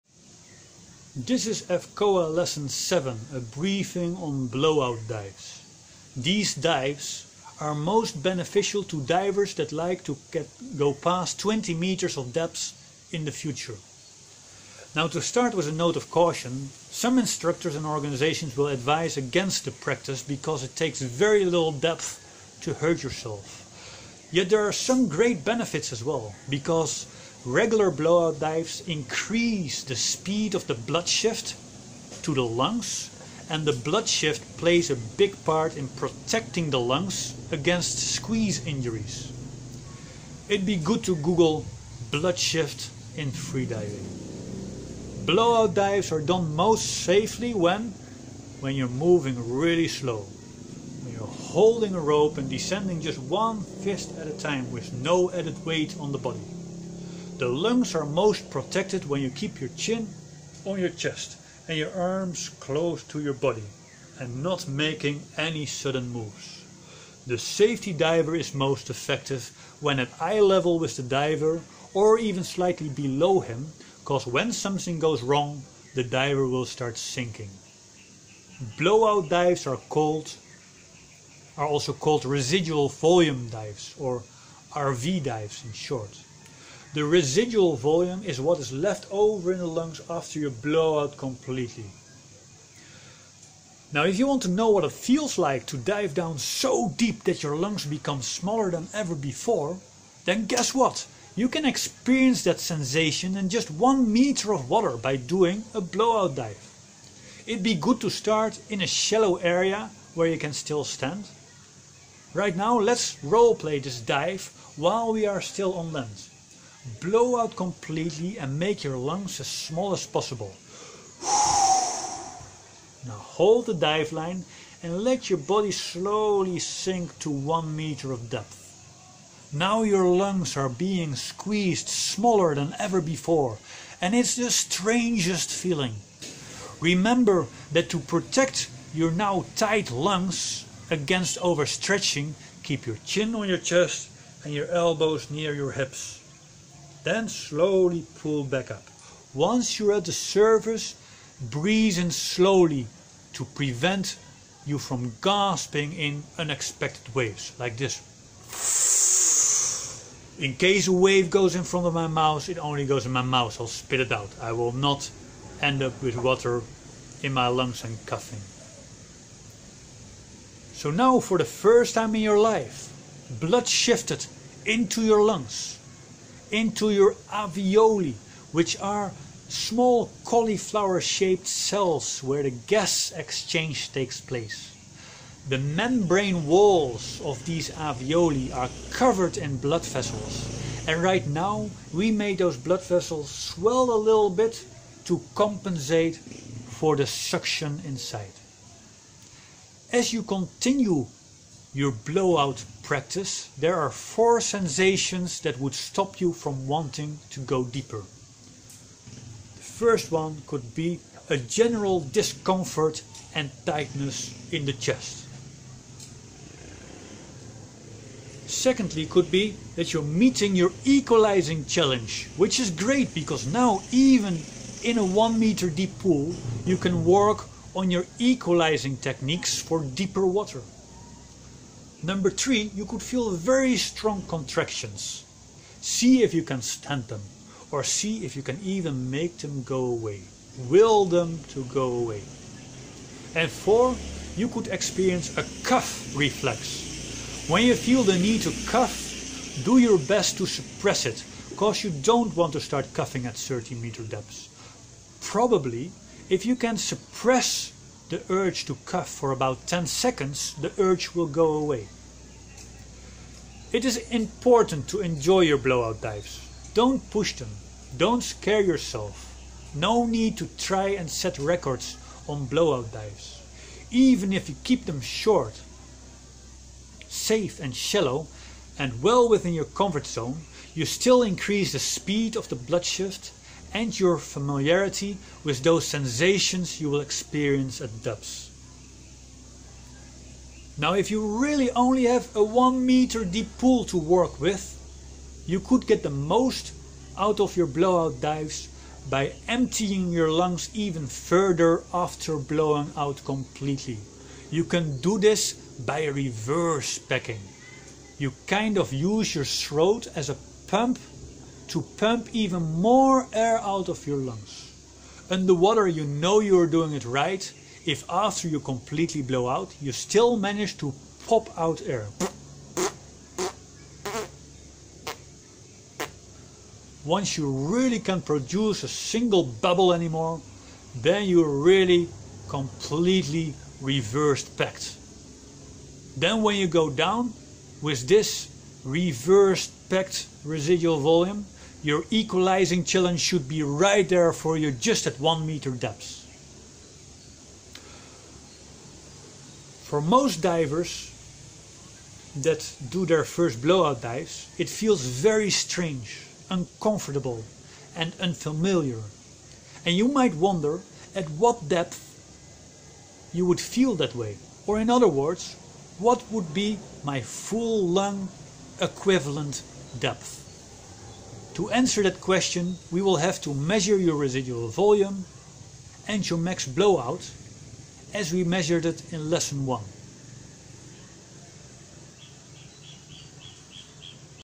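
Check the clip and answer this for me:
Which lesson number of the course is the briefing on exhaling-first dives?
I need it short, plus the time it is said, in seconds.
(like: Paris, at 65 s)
7, at 2 s.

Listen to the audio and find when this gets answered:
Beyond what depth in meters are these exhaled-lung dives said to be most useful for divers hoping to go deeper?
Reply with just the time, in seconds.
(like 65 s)
11 s.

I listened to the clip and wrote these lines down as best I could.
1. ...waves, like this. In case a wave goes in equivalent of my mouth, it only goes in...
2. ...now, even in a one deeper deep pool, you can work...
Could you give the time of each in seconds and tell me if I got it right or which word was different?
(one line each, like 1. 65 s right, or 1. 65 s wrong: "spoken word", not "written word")
1. 157 s wrong: "front", not "equivalent"
2. 223 s wrong: "meter", not "deeper".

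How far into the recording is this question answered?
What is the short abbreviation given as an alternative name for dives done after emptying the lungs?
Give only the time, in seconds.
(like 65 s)
84 s.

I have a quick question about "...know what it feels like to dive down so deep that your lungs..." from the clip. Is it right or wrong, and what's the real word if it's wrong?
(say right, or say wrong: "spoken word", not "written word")
right.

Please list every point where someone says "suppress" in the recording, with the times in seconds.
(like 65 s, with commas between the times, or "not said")
250 s, 256 s.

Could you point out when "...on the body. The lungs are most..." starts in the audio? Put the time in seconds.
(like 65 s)
55 s.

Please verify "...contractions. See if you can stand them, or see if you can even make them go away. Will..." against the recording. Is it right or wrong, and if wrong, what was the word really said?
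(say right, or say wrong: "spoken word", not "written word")
right.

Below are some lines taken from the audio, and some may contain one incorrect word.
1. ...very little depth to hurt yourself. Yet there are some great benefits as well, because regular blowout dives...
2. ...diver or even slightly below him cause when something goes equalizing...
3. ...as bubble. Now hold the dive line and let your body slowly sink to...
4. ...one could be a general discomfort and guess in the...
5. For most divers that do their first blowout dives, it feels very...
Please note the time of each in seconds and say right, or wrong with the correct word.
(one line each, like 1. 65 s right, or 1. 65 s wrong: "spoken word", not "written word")
1. 21 s right
2. 71 s wrong: "wrong", not "equalizing"
3. 119 s wrong: "possible", not "bubble"
4. 210 s wrong: "tightness", not "guess"
5. 349 s right.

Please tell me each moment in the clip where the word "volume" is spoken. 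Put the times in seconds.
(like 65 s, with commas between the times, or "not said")
82 s, 87 s, 340 s, 374 s.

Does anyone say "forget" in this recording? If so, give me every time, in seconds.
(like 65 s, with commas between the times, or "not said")
not said.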